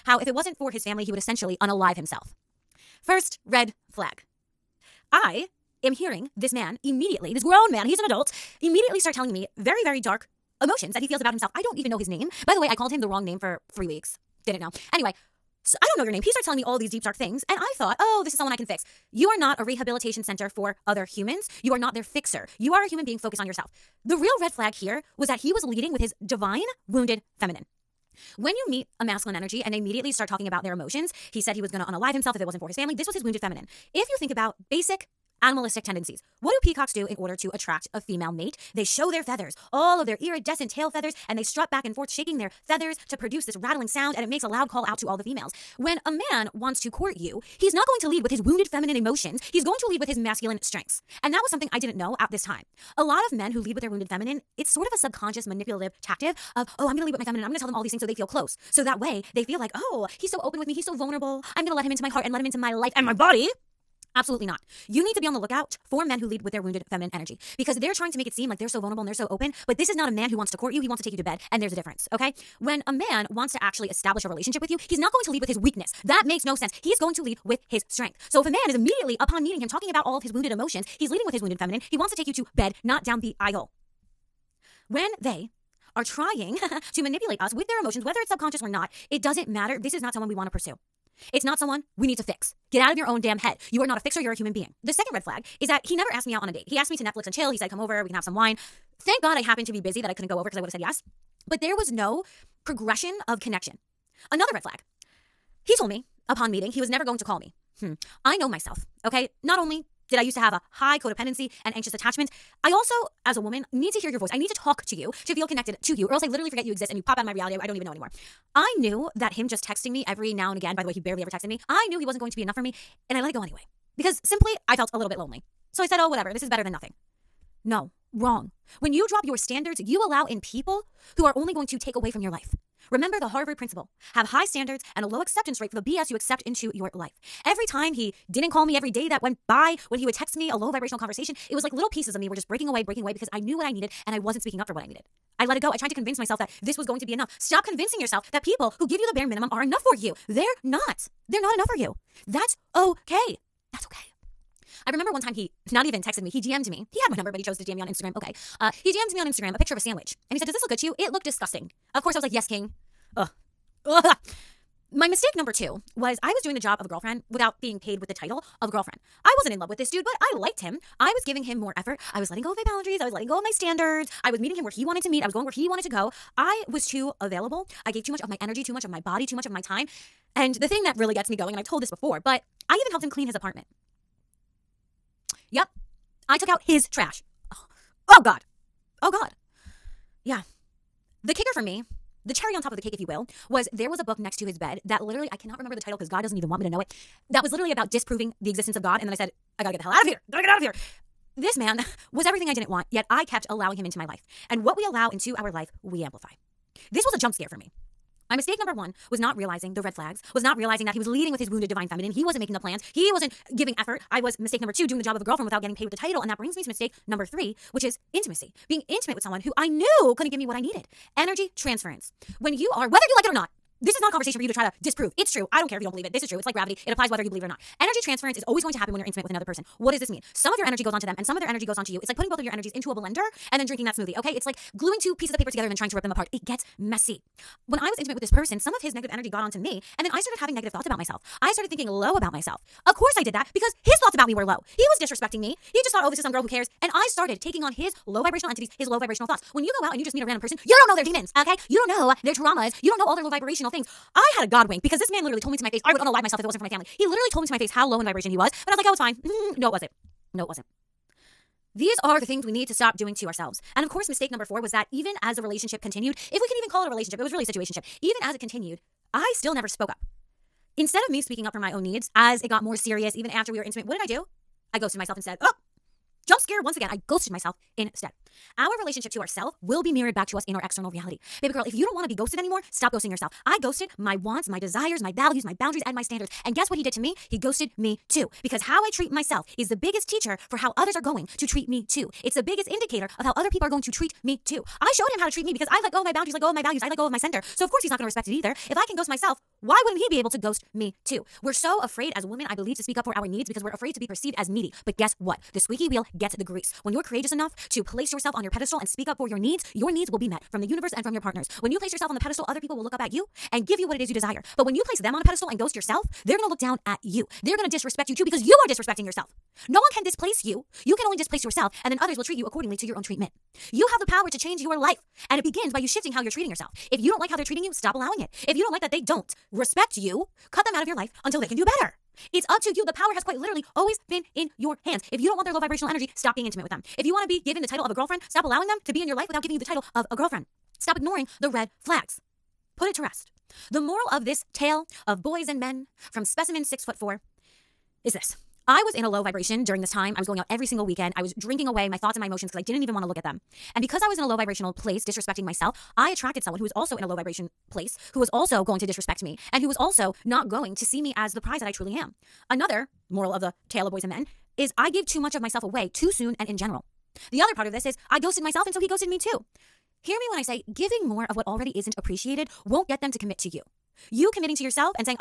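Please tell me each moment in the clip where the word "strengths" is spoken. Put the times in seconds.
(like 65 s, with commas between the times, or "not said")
50 s, 77 s.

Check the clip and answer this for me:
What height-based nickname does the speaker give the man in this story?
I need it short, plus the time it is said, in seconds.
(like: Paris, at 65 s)
Specimen six foot four, at 346 s.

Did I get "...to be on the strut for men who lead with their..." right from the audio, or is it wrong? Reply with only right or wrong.
wrong.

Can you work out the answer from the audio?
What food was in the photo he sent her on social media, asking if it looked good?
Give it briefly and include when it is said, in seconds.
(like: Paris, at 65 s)
A sandwich, at 159 s.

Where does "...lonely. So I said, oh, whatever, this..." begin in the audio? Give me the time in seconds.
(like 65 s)
125 s.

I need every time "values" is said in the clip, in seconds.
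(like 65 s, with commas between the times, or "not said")
285 s, 296 s.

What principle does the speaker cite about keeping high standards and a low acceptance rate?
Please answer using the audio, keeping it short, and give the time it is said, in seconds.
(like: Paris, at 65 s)
Harvard principle, at 133 s.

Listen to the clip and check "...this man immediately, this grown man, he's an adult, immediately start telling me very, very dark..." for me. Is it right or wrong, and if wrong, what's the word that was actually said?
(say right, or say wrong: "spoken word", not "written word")
right.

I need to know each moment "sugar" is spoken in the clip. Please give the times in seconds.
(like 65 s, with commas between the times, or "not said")
not said.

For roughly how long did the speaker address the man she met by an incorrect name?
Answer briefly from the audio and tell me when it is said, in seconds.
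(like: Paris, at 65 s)
3 weeks, at 13 s.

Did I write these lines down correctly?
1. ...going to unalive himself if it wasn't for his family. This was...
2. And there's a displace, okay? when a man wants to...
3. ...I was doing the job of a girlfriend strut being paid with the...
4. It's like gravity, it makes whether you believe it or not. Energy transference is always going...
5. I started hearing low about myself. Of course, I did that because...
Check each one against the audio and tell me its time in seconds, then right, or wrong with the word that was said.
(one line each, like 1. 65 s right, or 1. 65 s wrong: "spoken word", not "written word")
1. 31 s right
2. 71 s wrong: "difference", not "displace"
3. 166 s wrong: "without", not "strut"
4. 226 s wrong: "applies", not "makes"
5. 241 s wrong: "thinking", not "hearing".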